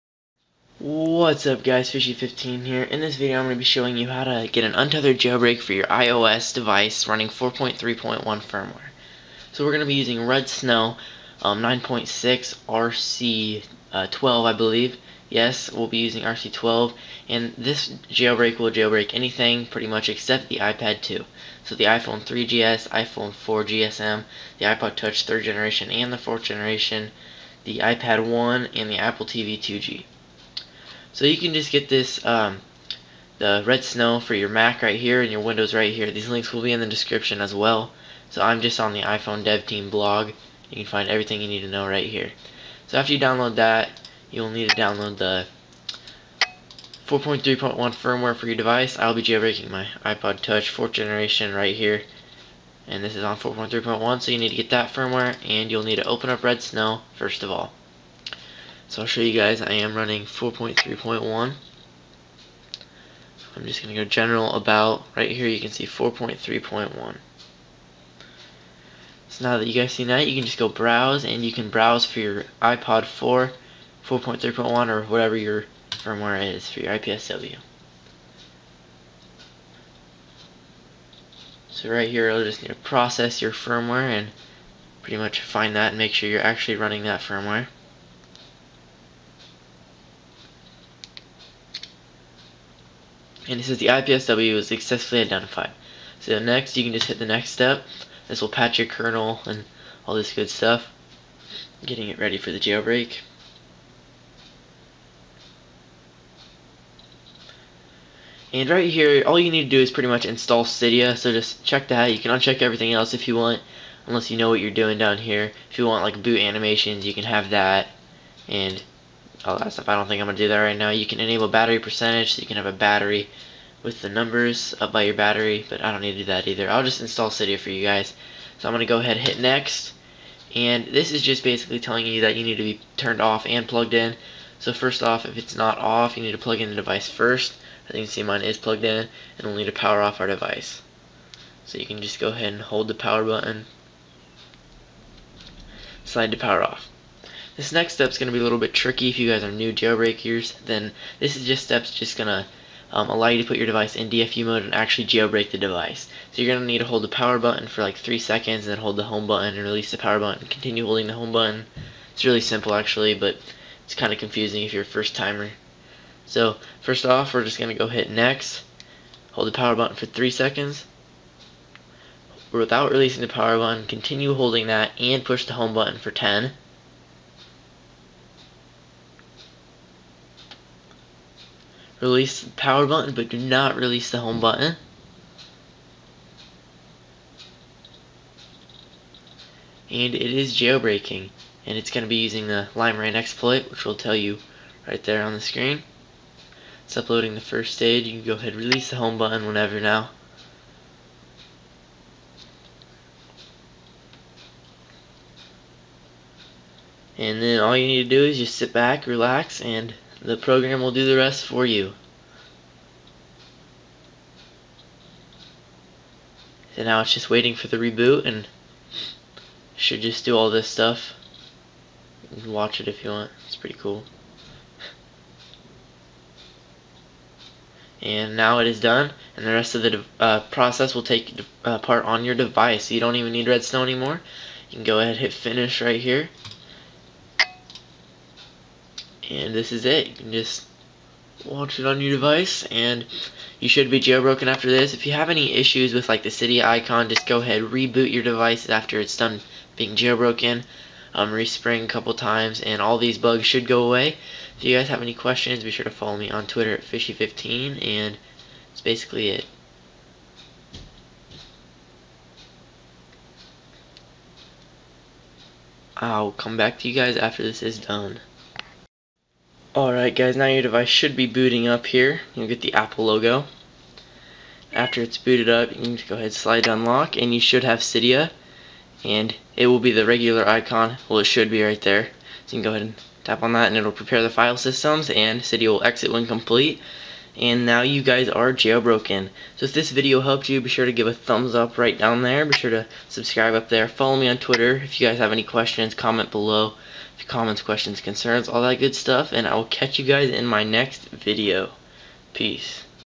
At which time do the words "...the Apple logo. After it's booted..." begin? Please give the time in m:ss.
4:32.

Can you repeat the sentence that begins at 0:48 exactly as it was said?
I'll be jailbreaking my iPod Touch 4th generation right here.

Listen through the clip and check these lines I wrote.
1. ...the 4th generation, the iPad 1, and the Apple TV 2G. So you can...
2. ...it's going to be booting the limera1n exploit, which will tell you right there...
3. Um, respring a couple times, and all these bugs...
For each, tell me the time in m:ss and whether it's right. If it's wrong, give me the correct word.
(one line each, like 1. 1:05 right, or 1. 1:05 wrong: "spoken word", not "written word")
1. 0:26 right
2. 3:11 wrong: "using", not "booting"
3. 4:11 right.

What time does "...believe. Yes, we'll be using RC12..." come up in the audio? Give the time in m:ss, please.
0:14.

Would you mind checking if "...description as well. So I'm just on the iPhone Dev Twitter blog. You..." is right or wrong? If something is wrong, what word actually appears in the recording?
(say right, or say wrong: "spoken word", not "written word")
wrong: "Team", not "Twitter".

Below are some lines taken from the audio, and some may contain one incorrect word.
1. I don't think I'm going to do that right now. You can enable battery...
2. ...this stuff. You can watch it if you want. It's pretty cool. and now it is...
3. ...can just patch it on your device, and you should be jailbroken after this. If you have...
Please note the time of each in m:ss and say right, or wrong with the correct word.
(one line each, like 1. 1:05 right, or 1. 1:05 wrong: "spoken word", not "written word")
1. 1:59 right
2. 3:40 right
3. 4:00 wrong: "watch", not "patch".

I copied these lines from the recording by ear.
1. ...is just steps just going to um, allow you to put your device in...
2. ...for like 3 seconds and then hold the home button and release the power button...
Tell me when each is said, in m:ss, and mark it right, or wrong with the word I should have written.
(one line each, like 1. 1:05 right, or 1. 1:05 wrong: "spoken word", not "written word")
1. 2:31 right
2. 2:37 right.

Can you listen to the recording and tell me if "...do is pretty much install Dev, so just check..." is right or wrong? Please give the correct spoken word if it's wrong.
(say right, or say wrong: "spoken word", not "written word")
wrong: "Cydia", not "Dev".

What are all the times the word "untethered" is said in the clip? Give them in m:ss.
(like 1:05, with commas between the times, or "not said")
0:04.